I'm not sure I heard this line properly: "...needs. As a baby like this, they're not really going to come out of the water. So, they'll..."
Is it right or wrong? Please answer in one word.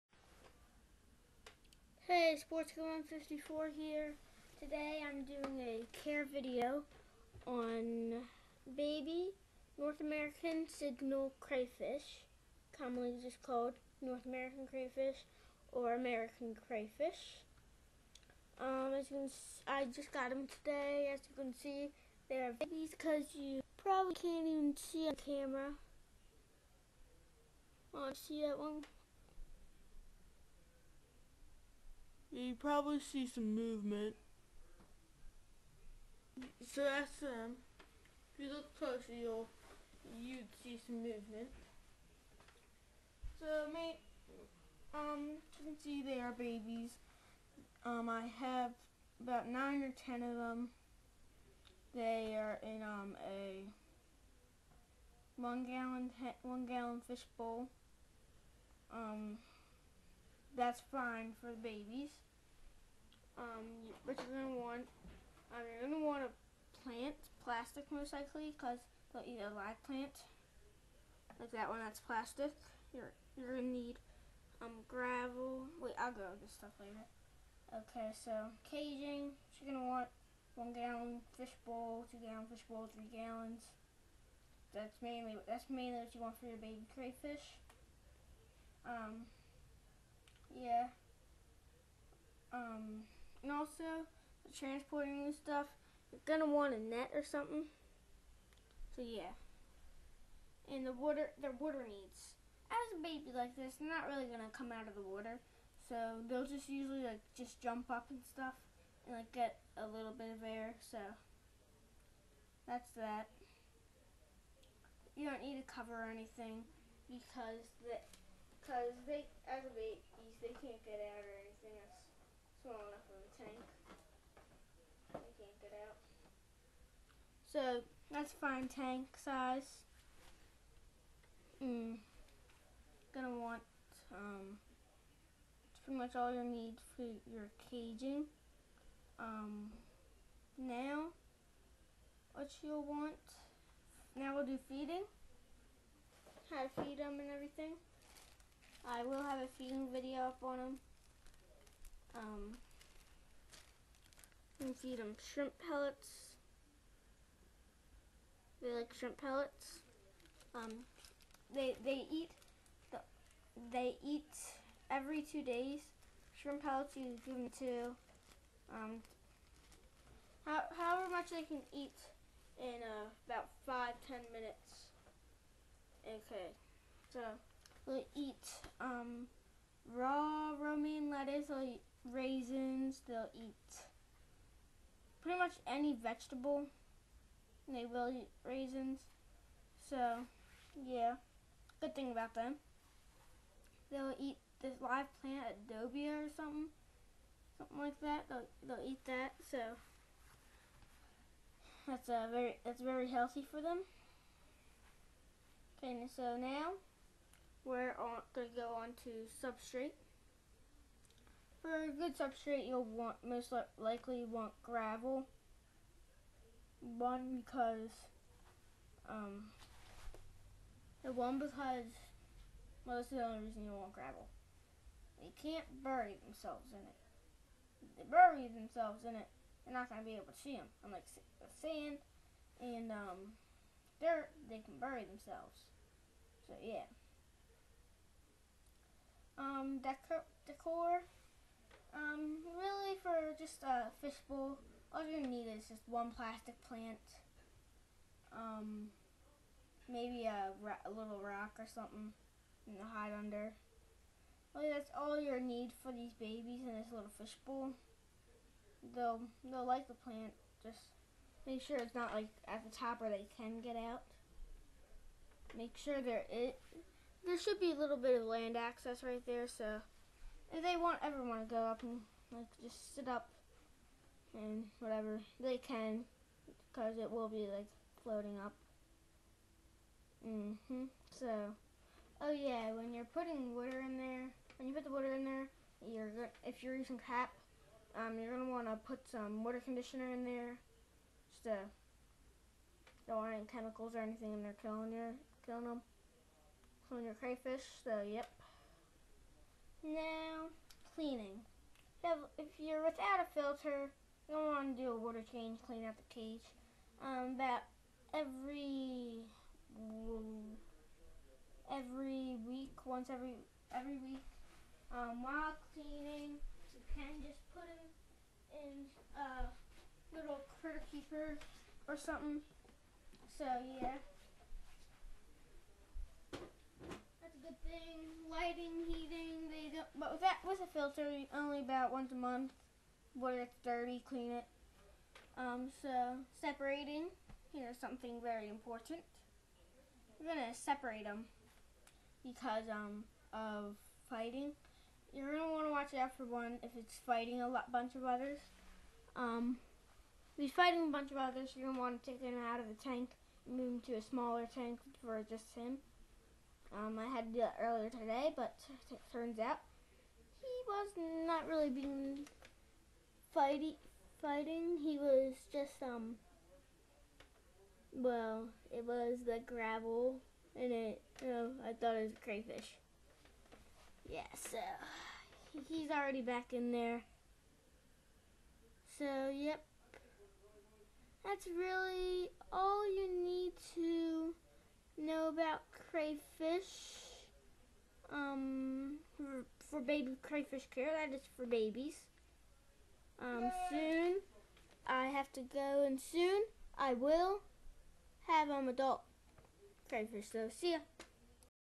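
right.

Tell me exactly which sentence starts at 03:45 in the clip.
They can't bury themselves in it.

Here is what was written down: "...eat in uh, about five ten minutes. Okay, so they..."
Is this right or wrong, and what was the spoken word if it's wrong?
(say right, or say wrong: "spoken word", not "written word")
right.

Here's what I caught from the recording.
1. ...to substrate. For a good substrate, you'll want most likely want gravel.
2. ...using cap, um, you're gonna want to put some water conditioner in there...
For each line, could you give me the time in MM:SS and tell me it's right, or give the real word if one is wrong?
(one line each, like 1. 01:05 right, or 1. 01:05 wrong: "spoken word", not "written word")
1. 03:29 right
2. 04:46 right.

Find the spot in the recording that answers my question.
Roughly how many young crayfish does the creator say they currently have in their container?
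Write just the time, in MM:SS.
00:49.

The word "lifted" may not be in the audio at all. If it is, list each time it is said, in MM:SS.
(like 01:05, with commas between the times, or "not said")
not said.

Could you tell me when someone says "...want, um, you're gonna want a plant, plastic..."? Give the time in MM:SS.
01:04.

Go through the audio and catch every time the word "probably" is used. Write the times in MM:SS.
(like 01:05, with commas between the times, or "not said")
00:23, 00:32.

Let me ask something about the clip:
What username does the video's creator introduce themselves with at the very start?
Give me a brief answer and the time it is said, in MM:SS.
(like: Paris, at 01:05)
Sportskid154, at 00:02.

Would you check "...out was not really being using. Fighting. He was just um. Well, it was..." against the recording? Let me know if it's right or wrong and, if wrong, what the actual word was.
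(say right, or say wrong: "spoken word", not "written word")
wrong: "fighting", not "using".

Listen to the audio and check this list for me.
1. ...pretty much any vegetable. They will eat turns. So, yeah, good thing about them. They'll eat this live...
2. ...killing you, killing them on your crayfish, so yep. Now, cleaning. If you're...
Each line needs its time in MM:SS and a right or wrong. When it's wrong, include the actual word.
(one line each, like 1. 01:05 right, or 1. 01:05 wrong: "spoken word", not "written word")
1. 03:05 wrong: "raisins", not "turns"
2. 04:54 right.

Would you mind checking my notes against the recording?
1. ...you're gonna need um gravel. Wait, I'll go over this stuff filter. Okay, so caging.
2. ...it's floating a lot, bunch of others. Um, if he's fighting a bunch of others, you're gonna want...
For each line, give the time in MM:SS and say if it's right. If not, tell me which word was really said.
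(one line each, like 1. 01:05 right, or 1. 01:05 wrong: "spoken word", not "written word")
1. 01:13 wrong: "later", not "filter"
2. 05:46 wrong: "fighting", not "floating".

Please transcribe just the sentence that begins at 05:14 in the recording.
Um, while cleaning, you can just put them in a uh, little critter keeper or something.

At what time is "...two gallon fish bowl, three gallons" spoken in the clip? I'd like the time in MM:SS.
01:22.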